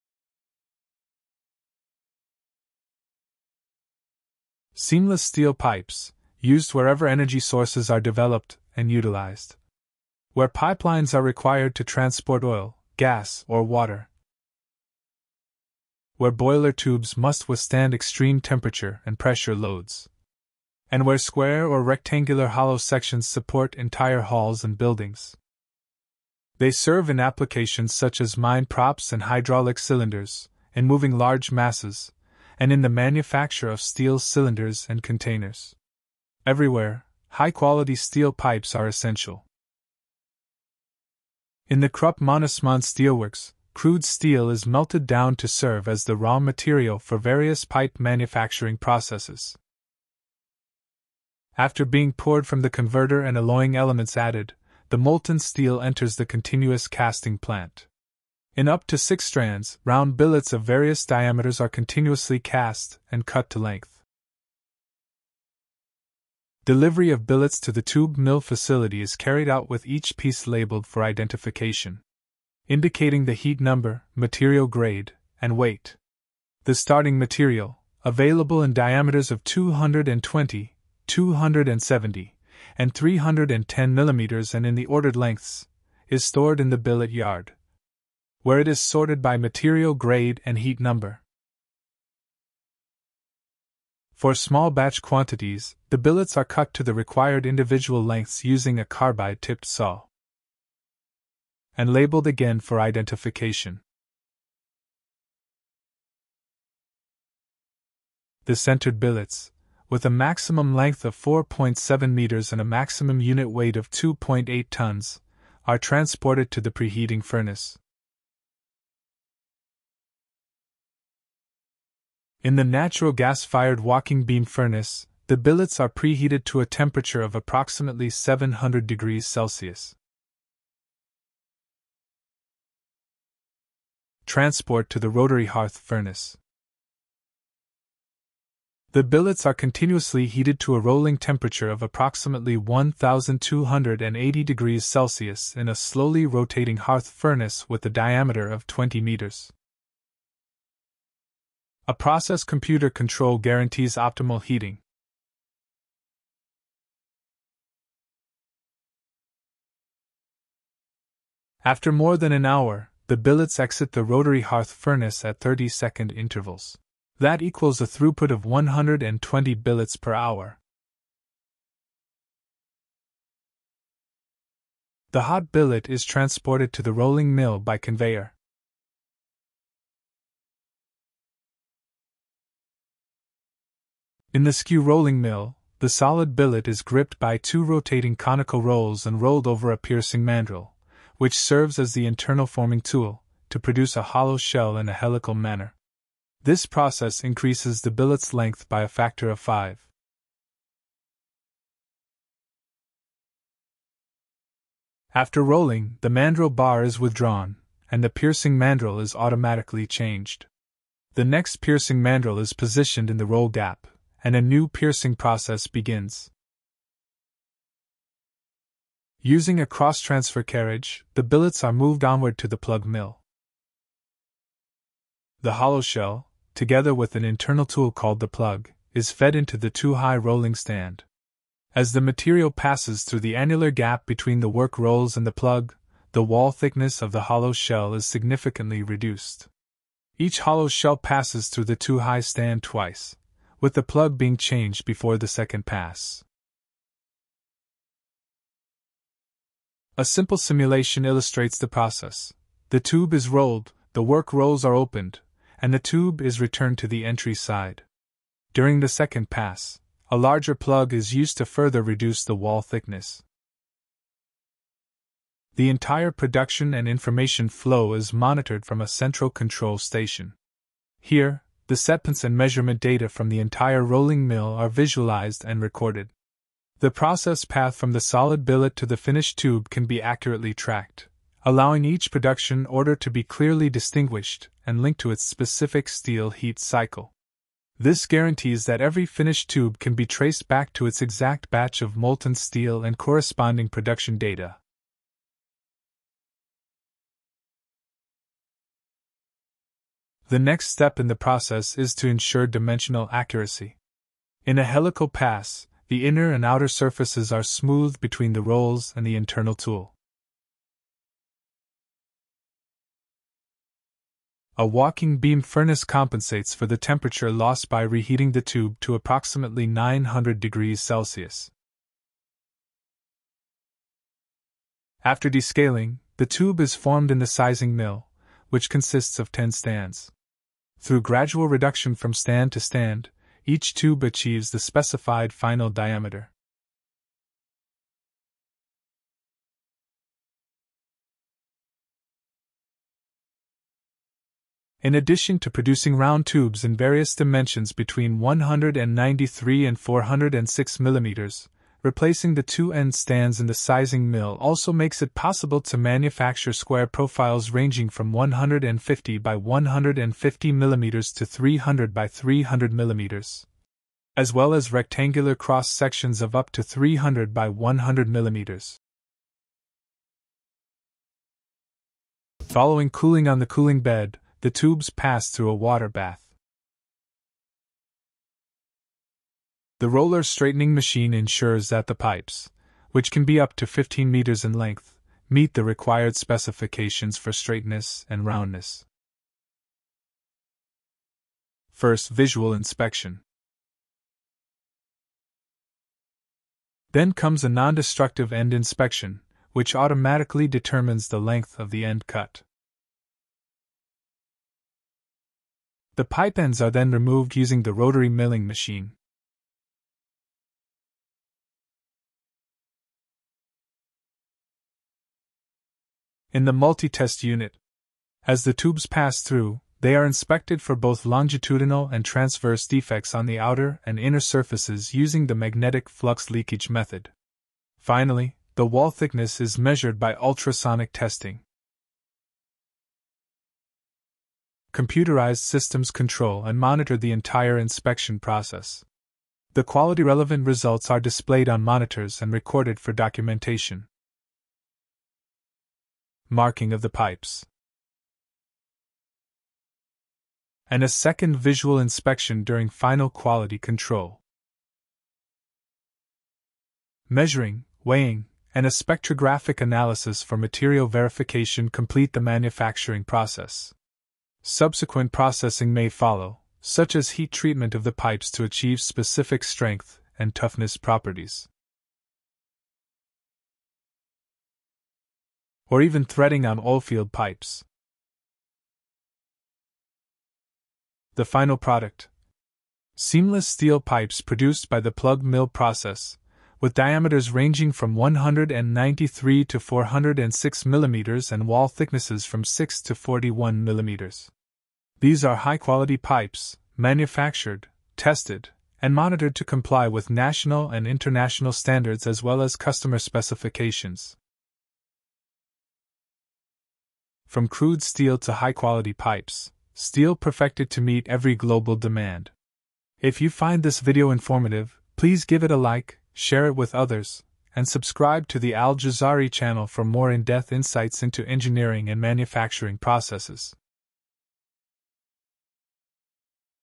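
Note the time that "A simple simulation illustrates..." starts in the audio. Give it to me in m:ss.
4:09.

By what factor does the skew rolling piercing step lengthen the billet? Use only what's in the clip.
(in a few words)
5.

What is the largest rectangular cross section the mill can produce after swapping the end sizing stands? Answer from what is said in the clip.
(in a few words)
300 by 100 mm.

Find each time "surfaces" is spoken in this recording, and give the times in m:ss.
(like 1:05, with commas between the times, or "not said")
5:06, 7:04.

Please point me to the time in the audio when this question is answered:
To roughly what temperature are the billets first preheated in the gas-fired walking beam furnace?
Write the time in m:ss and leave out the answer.
2:08.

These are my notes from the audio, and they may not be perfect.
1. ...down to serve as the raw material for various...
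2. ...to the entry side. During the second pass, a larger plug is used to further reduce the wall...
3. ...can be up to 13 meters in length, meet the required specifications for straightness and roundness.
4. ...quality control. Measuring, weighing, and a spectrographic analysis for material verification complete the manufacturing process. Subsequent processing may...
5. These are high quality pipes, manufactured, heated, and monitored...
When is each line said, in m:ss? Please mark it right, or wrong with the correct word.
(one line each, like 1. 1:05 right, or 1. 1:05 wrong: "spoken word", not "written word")
1. 0:45 right
2. 4:16 right
3. 6:23 wrong: "15", not "13"
4. 7:33 right
5. 8:14 wrong: "tested", not "heated".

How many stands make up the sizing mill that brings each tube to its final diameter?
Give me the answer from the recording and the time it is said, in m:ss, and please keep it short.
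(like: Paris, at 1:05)
10, at 5:29.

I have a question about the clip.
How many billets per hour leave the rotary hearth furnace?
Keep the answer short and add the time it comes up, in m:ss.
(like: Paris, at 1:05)
120, at 2:48.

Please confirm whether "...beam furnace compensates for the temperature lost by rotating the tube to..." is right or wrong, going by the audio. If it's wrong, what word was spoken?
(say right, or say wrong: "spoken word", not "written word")
wrong: "reheating", not "rotating".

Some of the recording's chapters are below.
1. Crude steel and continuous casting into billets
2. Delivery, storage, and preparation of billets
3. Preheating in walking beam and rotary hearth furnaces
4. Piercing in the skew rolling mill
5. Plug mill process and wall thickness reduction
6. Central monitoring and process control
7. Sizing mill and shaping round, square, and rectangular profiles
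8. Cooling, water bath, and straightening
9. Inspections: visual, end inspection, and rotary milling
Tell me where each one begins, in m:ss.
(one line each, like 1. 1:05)
1. 0:41
2. 1:06
3. 1:55
4. 3:00
5. 3:40
6. 4:25
7. 5:00
8. 6:10
9. 6:30.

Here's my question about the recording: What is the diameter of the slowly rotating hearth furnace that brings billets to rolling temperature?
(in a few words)
20 meters.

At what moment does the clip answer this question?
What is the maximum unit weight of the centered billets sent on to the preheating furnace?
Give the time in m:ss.
1:53.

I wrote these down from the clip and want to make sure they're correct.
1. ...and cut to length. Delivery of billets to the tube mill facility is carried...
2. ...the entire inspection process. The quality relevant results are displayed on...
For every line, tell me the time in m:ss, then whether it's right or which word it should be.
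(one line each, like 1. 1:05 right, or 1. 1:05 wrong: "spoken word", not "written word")
1. 1:03 right
2. 7:16 right.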